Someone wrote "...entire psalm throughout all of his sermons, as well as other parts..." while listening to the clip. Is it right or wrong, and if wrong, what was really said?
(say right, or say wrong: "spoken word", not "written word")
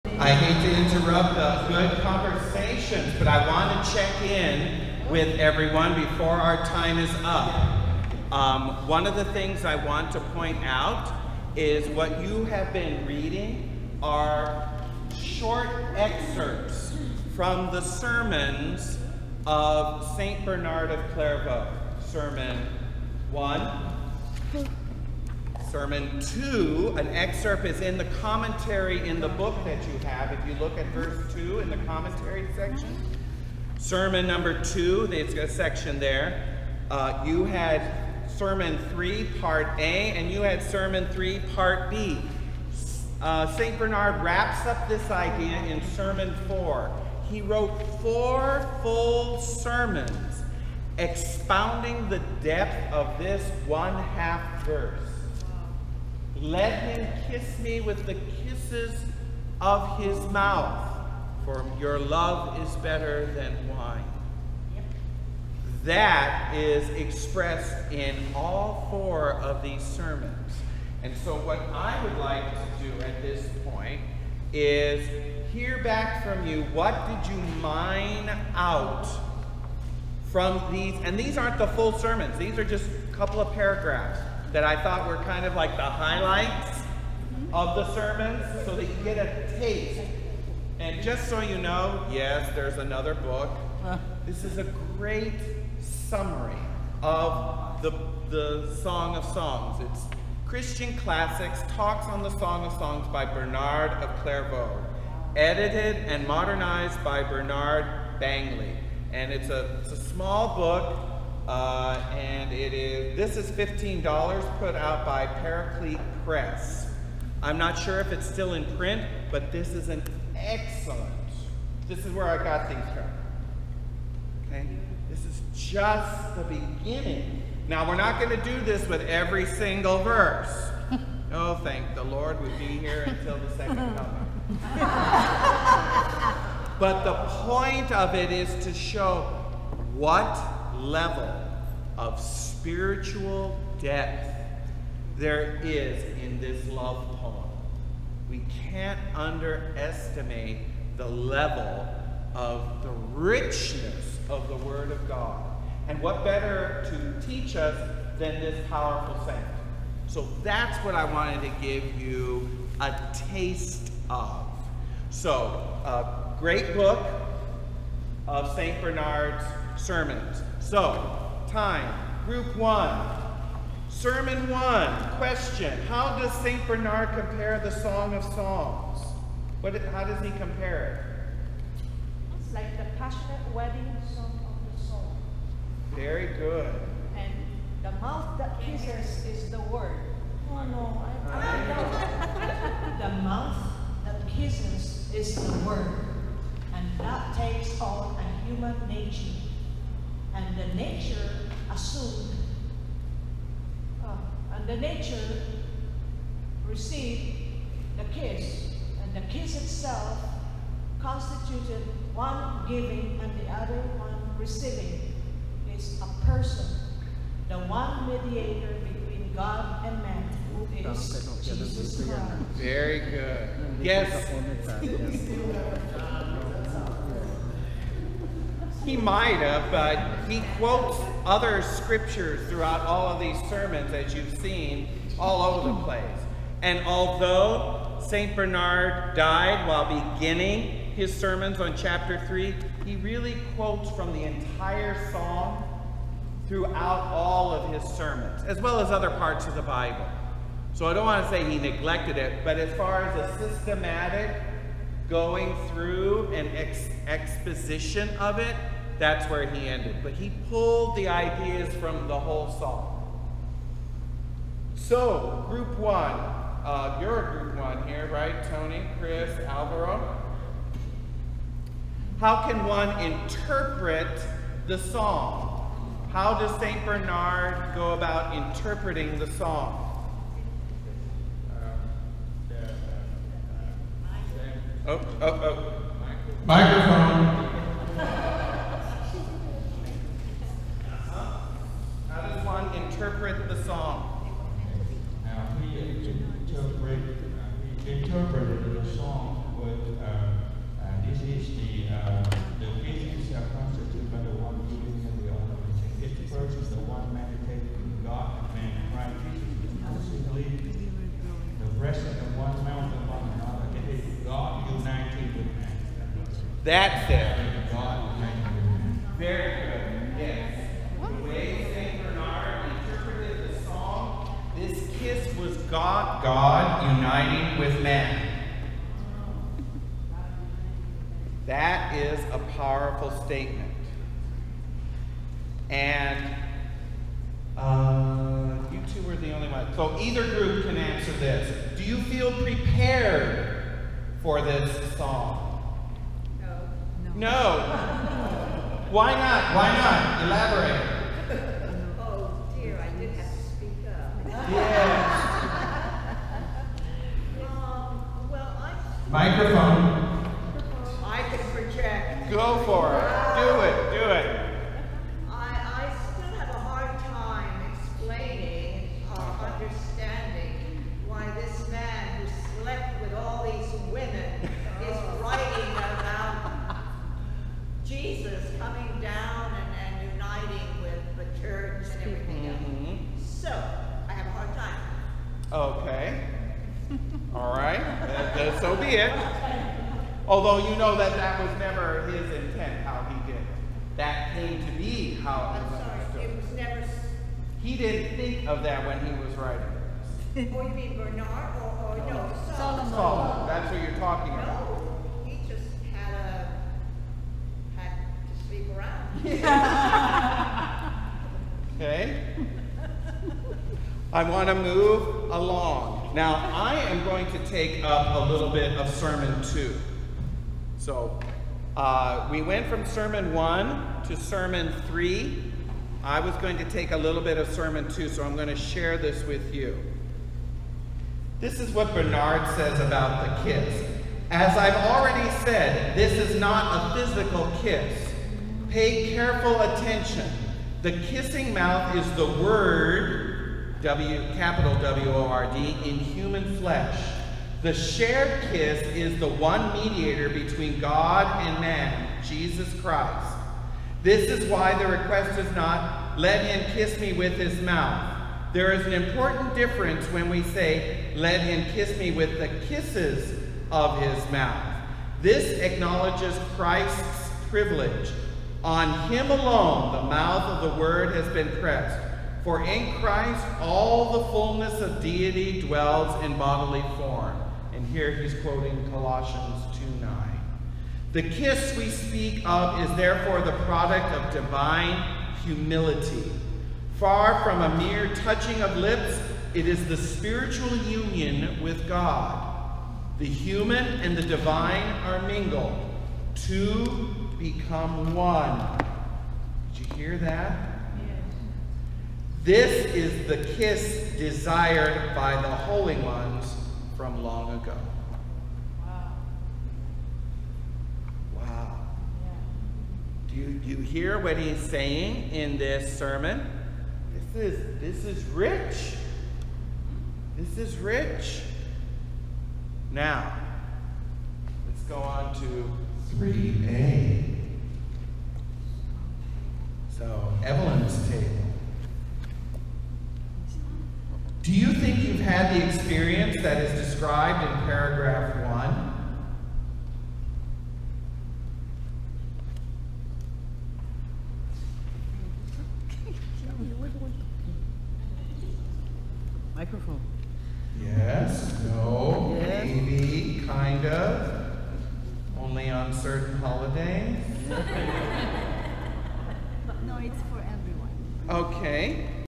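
right.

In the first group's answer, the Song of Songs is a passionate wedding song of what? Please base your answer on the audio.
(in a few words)
the soul.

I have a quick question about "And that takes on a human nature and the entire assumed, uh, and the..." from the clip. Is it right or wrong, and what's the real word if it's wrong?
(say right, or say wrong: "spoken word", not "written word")
wrong: "nature", not "entire".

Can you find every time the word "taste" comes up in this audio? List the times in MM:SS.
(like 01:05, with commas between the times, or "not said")
01:29, 02:43.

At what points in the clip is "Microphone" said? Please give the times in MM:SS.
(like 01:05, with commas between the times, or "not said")
04:46, 05:59, 09:09.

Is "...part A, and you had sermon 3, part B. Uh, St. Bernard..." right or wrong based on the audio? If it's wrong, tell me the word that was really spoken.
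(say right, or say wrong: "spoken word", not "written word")
right.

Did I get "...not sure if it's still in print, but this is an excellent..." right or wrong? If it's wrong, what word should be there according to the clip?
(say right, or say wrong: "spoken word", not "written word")
right.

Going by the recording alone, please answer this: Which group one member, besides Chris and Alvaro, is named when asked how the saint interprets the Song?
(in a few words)
Tony.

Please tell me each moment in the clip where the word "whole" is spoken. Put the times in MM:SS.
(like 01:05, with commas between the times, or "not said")
04:22.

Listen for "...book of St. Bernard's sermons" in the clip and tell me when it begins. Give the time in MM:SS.
02:46.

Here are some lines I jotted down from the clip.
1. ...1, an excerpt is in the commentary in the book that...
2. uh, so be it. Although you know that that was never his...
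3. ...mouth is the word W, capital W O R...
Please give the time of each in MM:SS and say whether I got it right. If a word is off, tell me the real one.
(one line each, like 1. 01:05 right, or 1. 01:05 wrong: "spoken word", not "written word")
1. 00:26 wrong: "2", not "1"
2. 06:28 right
3. 07:21 right.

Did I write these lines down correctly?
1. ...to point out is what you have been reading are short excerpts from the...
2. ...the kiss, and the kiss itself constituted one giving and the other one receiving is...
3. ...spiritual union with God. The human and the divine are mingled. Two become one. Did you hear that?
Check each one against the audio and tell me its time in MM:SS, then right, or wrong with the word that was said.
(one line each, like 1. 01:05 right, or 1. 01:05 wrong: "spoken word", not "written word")
1. 00:10 right
2. 03:27 right
3. 08:09 right.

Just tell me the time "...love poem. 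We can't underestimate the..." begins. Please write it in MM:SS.
02:26.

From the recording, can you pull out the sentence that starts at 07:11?
This is what Bernard says about the kiss.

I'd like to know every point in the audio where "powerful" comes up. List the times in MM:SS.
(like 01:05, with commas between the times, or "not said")
02:38, 05:32.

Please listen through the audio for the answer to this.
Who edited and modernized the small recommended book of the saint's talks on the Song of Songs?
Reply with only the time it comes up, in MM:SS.
01:47.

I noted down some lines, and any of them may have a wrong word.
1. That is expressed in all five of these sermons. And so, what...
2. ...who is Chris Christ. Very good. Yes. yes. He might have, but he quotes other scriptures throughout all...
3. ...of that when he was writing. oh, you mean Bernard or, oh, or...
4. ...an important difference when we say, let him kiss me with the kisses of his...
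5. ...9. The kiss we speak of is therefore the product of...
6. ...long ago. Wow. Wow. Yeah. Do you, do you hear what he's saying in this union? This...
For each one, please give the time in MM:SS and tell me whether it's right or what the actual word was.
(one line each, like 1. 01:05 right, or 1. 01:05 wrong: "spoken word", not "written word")
1. 01:05 wrong: "four", not "five"
2. 03:40 wrong: "Jesus", not "Chris"
3. 06:38 right
4. 07:38 right
5. 08:00 right
6. 08:27 wrong: "sermon", not "union".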